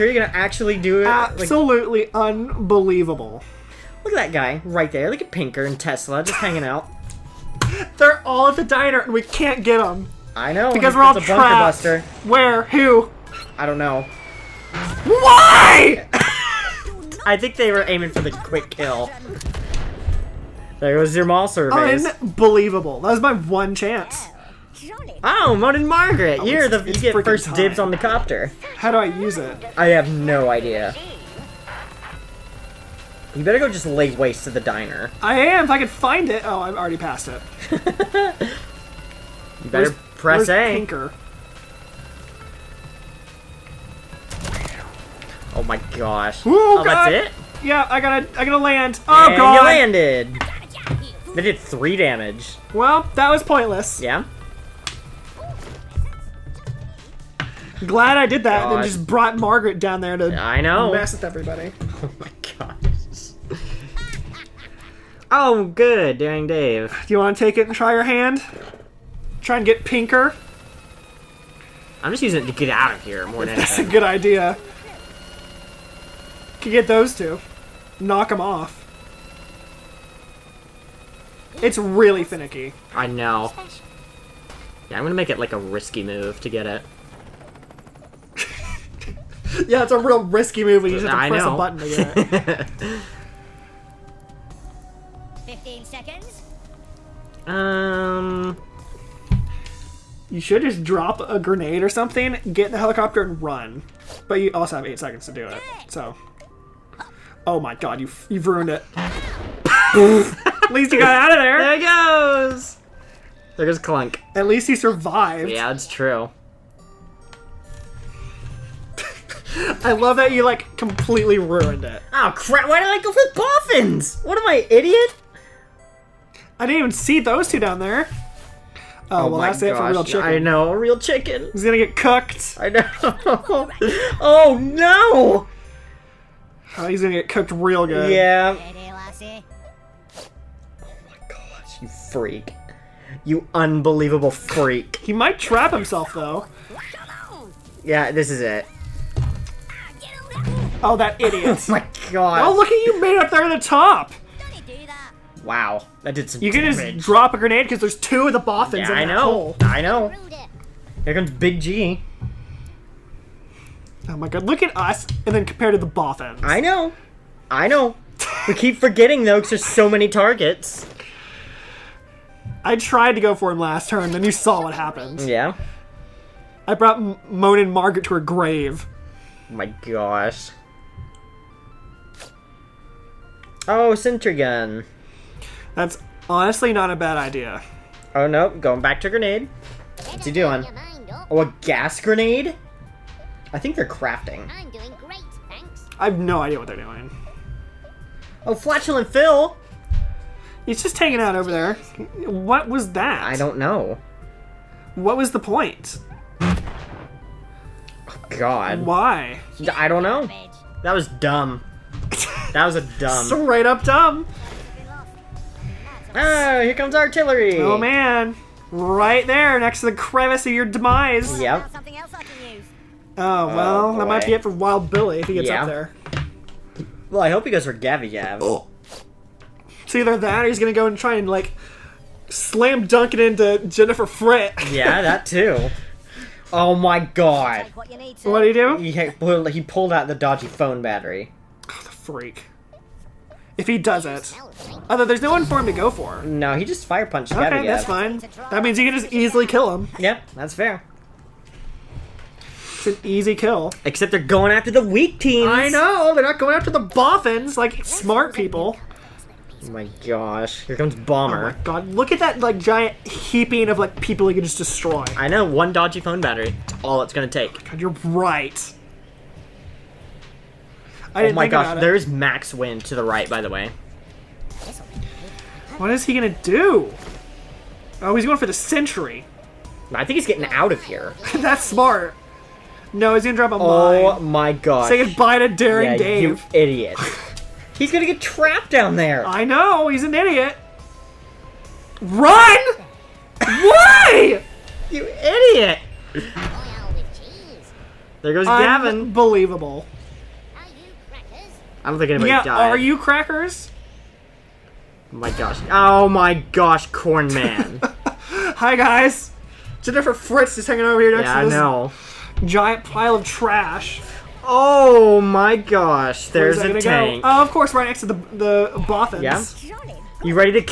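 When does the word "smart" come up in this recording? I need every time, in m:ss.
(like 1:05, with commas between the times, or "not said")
4:17, 4:41.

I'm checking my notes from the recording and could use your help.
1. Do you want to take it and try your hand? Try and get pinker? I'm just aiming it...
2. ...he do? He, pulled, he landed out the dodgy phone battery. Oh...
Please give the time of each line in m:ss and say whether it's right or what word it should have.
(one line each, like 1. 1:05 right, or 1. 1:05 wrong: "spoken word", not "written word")
1. 1:07 wrong: "using", not "aiming"
2. 3:58 wrong: "pulled", not "landed".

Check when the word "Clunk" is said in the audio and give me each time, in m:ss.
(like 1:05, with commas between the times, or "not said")
1:53.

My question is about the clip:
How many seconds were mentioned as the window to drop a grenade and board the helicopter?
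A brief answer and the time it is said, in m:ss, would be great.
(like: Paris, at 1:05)
8, at 1:44.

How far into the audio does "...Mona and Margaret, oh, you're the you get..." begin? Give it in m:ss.
0:25.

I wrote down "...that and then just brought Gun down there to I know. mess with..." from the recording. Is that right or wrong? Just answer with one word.
wrong.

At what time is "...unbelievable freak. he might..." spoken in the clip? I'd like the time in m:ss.
2:23.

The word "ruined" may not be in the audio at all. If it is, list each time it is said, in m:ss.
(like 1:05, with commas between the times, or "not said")
1:48, 2:01.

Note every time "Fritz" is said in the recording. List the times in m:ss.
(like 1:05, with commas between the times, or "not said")
3:54, 5:10.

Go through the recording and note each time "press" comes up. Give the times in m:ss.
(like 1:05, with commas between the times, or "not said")
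0:39, 1:31.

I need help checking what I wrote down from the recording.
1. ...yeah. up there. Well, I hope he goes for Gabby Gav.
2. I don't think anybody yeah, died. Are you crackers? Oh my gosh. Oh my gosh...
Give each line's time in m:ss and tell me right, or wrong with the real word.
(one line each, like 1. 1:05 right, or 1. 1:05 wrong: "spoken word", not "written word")
1. 3:45 right
2. 5:00 right.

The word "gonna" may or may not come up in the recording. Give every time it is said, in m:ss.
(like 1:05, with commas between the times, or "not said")
0:00, 1:25, 2:11, 2:17, 3:50, 4:43, 4:47.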